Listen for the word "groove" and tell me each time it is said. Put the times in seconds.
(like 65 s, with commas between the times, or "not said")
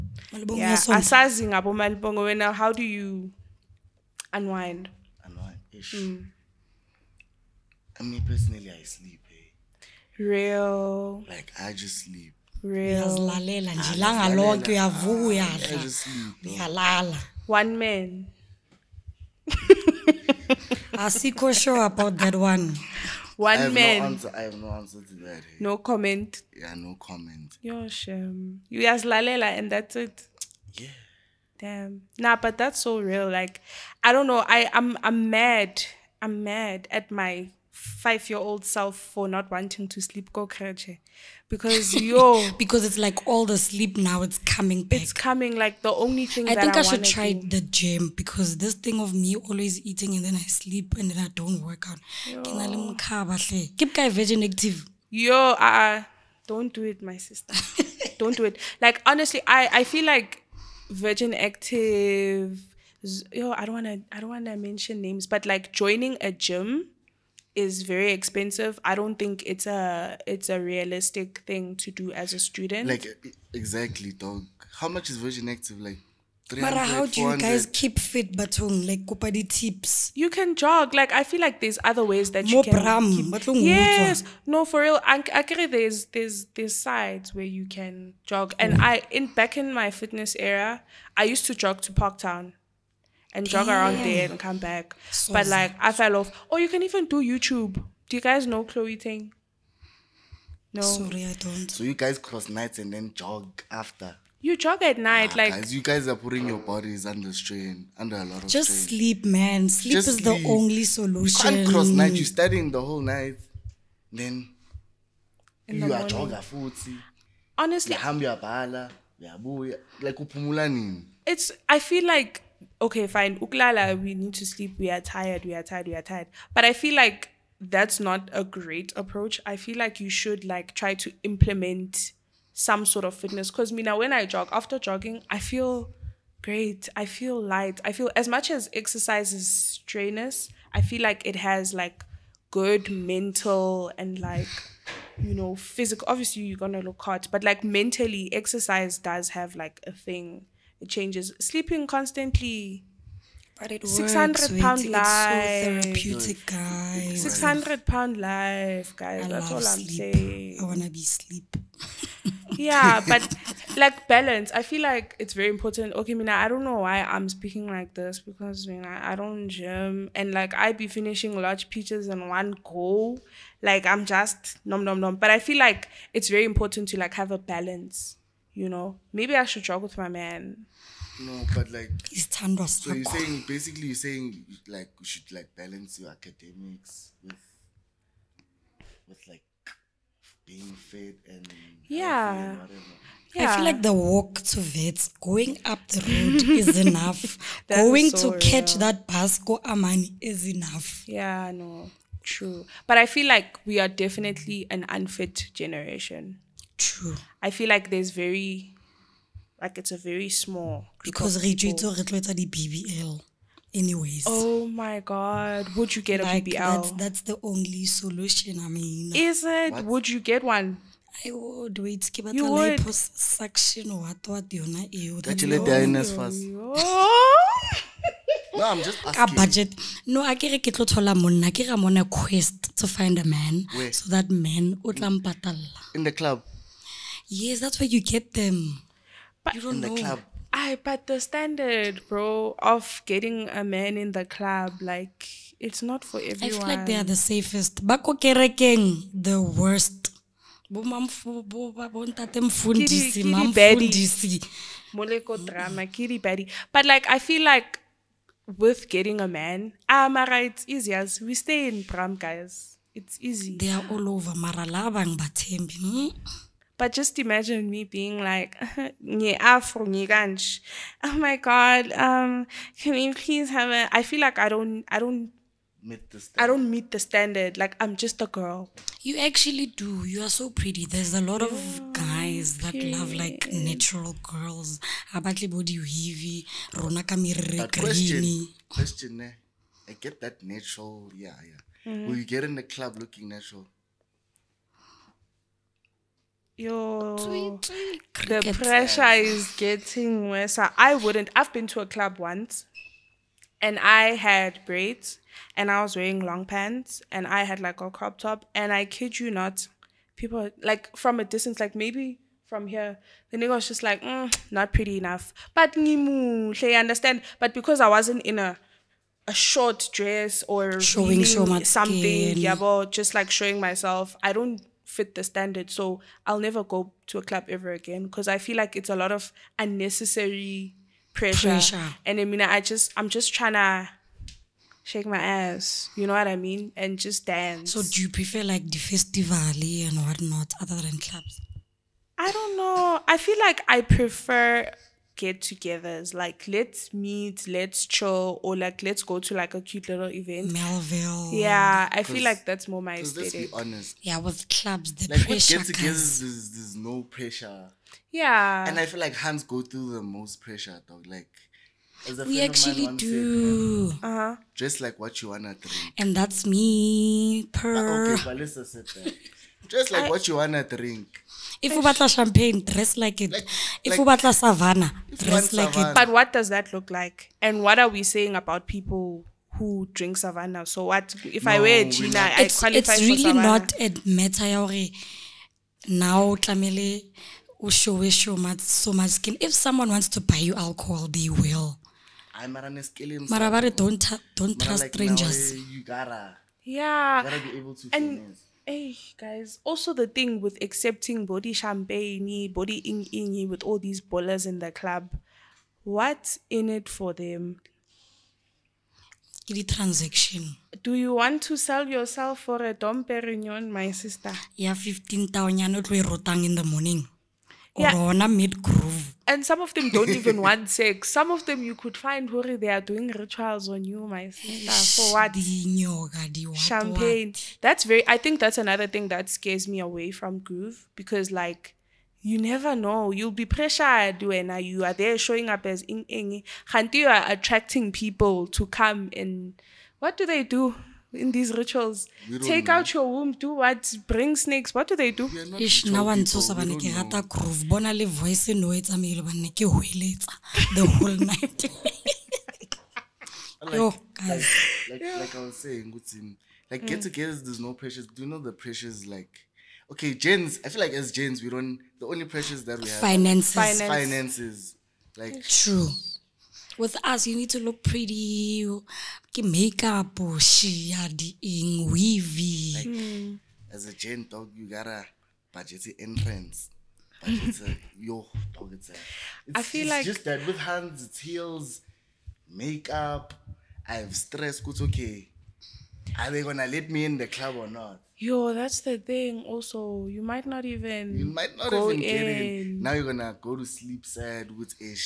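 418 s, 430 s, 447 s.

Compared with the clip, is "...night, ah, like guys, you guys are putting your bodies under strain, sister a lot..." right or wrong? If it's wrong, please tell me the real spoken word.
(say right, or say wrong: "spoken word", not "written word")
wrong: "under", not "sister".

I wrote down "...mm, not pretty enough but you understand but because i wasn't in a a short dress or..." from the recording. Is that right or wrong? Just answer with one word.
right.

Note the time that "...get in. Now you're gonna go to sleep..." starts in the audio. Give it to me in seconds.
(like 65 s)
492 s.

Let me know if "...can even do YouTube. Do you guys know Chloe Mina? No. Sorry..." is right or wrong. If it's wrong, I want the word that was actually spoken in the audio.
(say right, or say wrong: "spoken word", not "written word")
wrong: "Ting", not "Mina".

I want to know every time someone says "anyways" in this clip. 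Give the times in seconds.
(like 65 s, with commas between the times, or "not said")
213 s.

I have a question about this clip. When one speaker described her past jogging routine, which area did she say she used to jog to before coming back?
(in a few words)
Parktown.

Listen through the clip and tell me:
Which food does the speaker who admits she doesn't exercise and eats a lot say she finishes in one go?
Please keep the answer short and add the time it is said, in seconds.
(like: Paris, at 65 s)
Large peaches, at 171 s.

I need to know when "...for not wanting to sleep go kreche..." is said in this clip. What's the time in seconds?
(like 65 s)
38 s.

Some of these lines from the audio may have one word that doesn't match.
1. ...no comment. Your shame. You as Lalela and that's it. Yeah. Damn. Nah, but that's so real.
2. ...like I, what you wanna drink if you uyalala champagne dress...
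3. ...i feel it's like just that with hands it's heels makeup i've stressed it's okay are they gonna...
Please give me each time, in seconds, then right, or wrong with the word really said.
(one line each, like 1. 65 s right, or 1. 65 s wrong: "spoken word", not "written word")
1. 26 s right
2. 369 s wrong: "batla", not "uyalala"
3. 479 s right.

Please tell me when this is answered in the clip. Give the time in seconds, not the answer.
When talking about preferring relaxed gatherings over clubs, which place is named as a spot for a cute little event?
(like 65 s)
350 s.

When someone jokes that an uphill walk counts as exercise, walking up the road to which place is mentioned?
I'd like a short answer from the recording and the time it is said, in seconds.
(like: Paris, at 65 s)
Vets, at 194 s.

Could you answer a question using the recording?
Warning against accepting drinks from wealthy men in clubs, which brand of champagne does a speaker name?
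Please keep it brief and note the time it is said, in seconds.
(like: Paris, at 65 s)
Dom Perignon, at 412 s.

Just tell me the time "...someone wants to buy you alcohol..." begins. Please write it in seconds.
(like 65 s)
389 s.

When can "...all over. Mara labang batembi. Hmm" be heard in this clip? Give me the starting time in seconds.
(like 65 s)
263 s.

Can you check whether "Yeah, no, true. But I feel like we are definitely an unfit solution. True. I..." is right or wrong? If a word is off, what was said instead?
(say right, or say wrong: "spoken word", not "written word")
wrong: "generation", not "solution".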